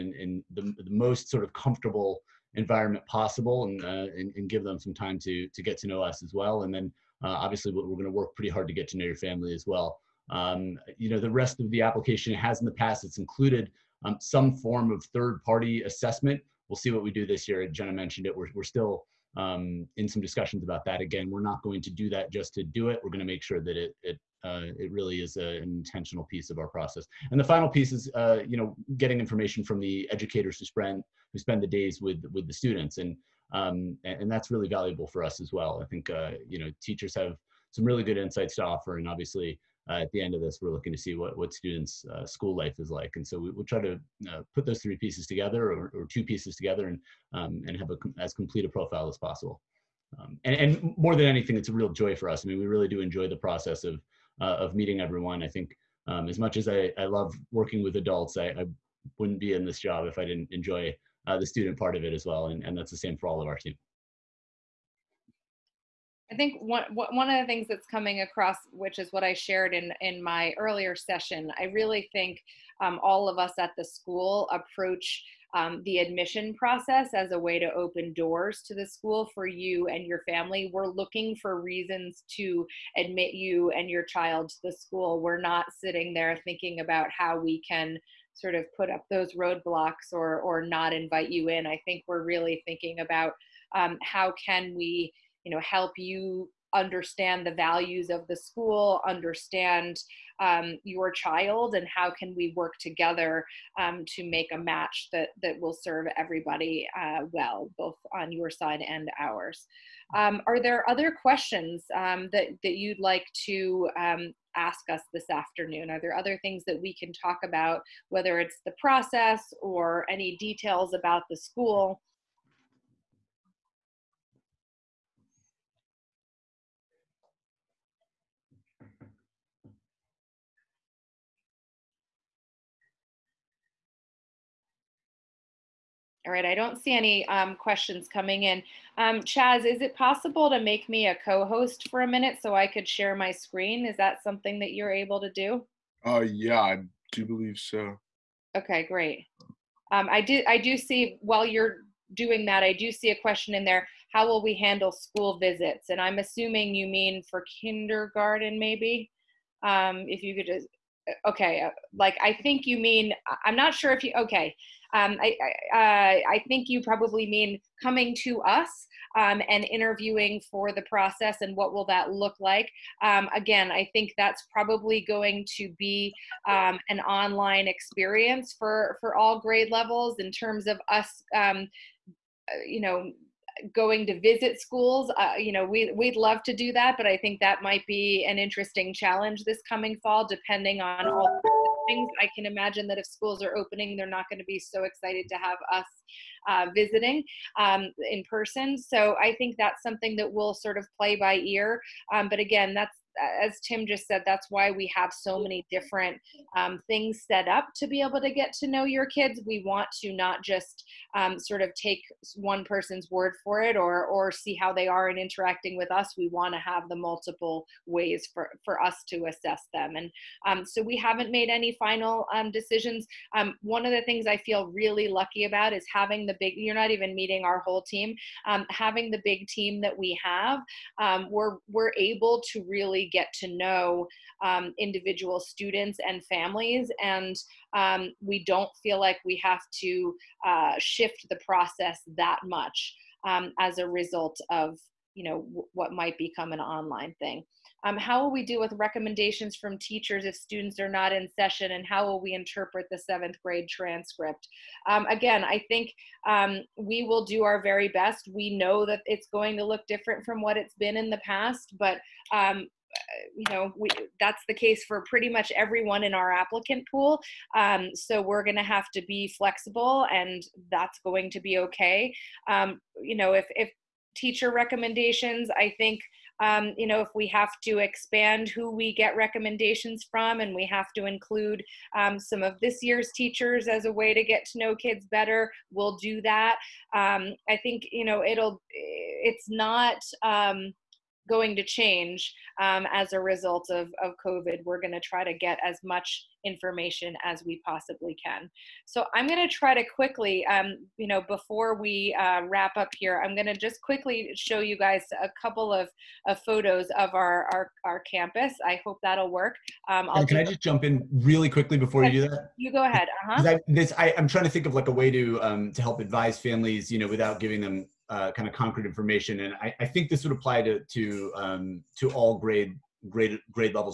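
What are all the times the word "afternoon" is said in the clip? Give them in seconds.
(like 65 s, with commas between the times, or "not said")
115 s.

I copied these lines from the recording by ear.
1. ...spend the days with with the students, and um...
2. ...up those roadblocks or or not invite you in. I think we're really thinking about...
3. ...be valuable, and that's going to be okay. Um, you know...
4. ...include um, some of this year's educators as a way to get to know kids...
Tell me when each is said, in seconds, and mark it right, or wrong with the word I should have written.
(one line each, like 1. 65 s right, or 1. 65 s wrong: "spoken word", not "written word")
1. 31 s right
2. 88 s right
3. 269 s wrong: "flexible", not "valuable"
4. 281 s wrong: "teachers", not "educators".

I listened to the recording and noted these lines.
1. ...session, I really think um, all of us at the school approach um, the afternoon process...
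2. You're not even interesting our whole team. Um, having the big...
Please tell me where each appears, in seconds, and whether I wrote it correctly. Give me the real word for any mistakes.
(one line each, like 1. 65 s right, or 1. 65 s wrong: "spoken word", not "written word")
1. 70 s wrong: "admission", not "afternoon"
2. 226 s wrong: "meeting", not "interesting".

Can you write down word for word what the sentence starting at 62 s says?
And, and that's the same for all of our team.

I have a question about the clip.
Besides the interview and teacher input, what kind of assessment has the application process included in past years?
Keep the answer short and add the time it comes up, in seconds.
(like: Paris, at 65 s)
third party assessment, at 15 s.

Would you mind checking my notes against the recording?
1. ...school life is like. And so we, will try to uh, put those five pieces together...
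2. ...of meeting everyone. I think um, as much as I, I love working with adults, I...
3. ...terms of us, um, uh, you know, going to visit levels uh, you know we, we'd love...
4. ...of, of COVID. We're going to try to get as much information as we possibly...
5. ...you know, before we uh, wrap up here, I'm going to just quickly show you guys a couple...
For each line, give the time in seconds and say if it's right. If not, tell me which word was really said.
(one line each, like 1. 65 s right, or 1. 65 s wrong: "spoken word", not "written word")
1. 42 s wrong: "three", not "five"
2. 54 s right
3. 180 s wrong: "schools", not "levels"
4. 293 s right
5. 300 s right.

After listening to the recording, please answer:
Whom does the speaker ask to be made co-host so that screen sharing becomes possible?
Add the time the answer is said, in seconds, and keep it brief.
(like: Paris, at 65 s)
Chaz, at 139 s.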